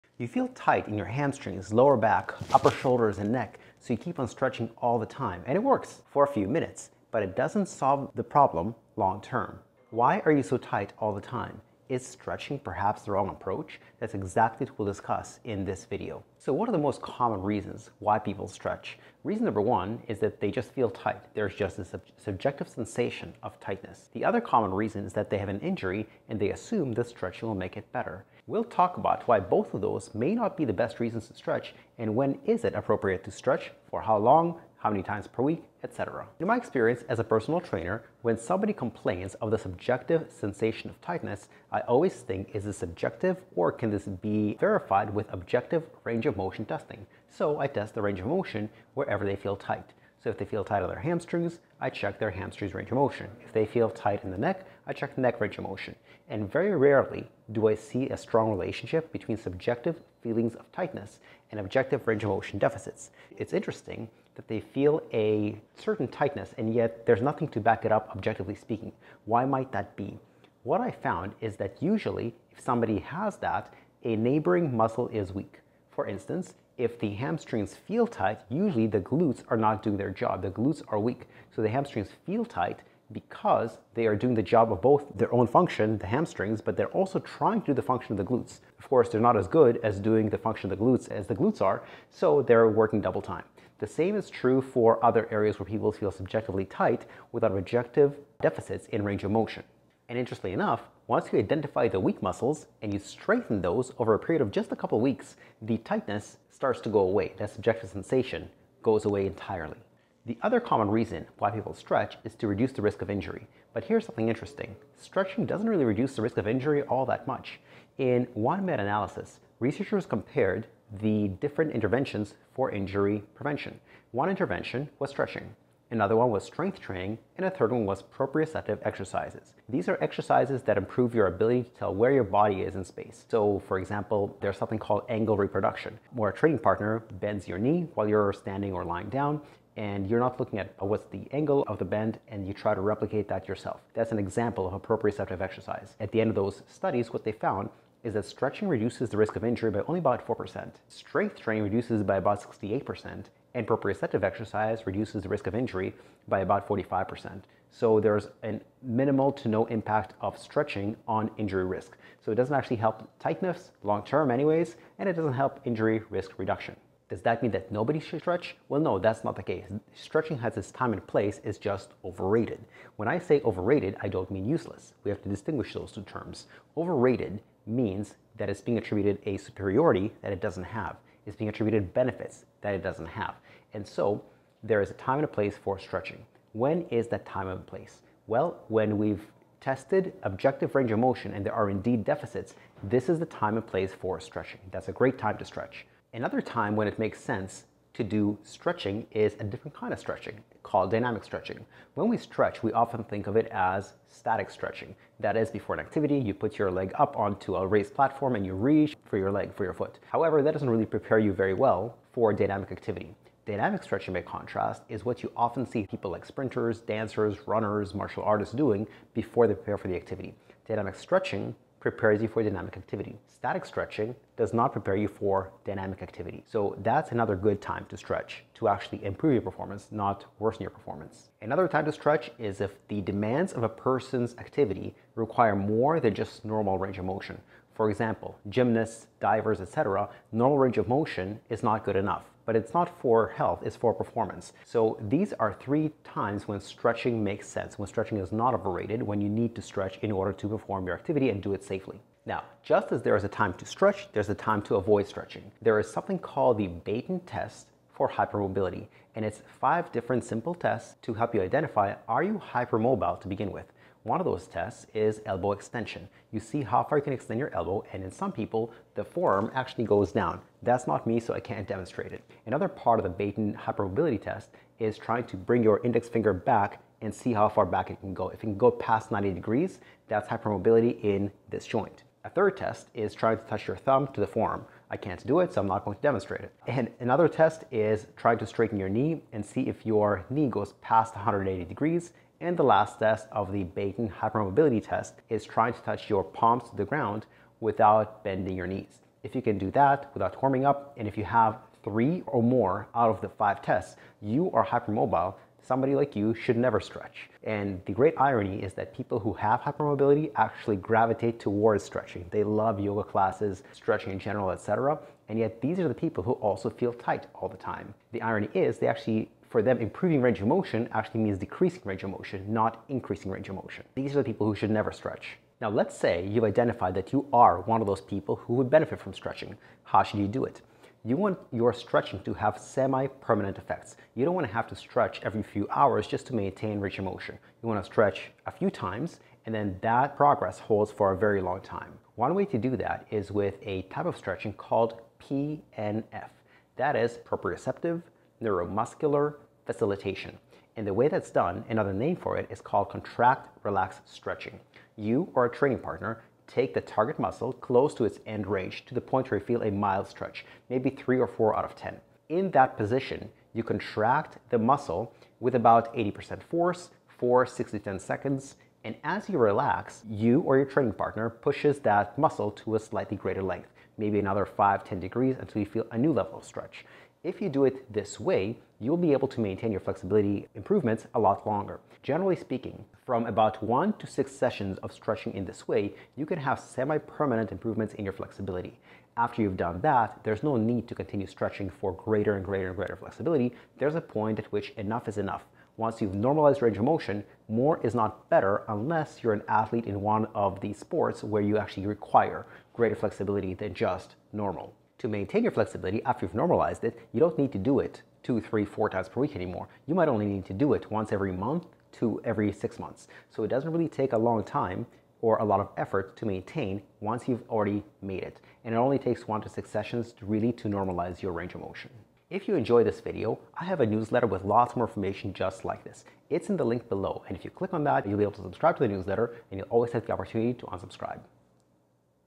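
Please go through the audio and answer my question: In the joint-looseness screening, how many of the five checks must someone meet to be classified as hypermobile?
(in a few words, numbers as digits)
3.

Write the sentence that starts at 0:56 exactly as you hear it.
And very rarely do I see a strong relationship between subjective feelings of tightness and objective range of motion deficits.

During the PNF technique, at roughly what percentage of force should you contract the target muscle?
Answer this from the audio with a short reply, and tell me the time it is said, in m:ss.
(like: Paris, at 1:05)
80%, at 6:05.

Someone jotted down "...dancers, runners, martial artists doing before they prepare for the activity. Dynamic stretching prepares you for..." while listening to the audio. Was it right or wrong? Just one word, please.
right.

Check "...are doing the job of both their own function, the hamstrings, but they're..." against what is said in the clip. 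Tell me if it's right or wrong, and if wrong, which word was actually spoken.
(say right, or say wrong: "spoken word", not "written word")
right.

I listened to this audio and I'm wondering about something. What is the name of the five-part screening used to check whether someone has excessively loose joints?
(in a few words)
Beighton test.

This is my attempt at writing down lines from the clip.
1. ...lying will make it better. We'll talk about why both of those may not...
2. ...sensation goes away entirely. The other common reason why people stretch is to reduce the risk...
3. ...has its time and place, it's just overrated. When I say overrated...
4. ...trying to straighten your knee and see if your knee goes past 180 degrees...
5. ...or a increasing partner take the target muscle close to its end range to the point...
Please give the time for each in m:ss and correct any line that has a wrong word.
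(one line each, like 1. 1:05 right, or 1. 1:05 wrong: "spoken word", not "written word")
1. 0:27 wrong: "stretching", not "lying"
2. 1:47 right
3. 2:50 right
4. 4:48 right
5. 5:55 wrong: "training", not "increasing".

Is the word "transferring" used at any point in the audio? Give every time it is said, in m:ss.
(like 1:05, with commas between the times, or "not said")
not said.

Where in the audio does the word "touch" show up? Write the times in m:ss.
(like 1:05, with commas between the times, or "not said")
4:43, 4:55.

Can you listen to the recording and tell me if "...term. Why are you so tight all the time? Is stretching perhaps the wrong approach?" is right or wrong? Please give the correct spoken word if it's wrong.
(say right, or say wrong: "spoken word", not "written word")
right.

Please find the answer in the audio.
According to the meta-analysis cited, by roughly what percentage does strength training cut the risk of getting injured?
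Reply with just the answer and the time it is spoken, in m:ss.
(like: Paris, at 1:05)
68%, at 2:32.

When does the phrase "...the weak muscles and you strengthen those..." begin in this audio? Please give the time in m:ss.
1:41.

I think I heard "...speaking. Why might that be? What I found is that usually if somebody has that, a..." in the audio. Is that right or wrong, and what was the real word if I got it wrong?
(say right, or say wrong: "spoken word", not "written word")
right.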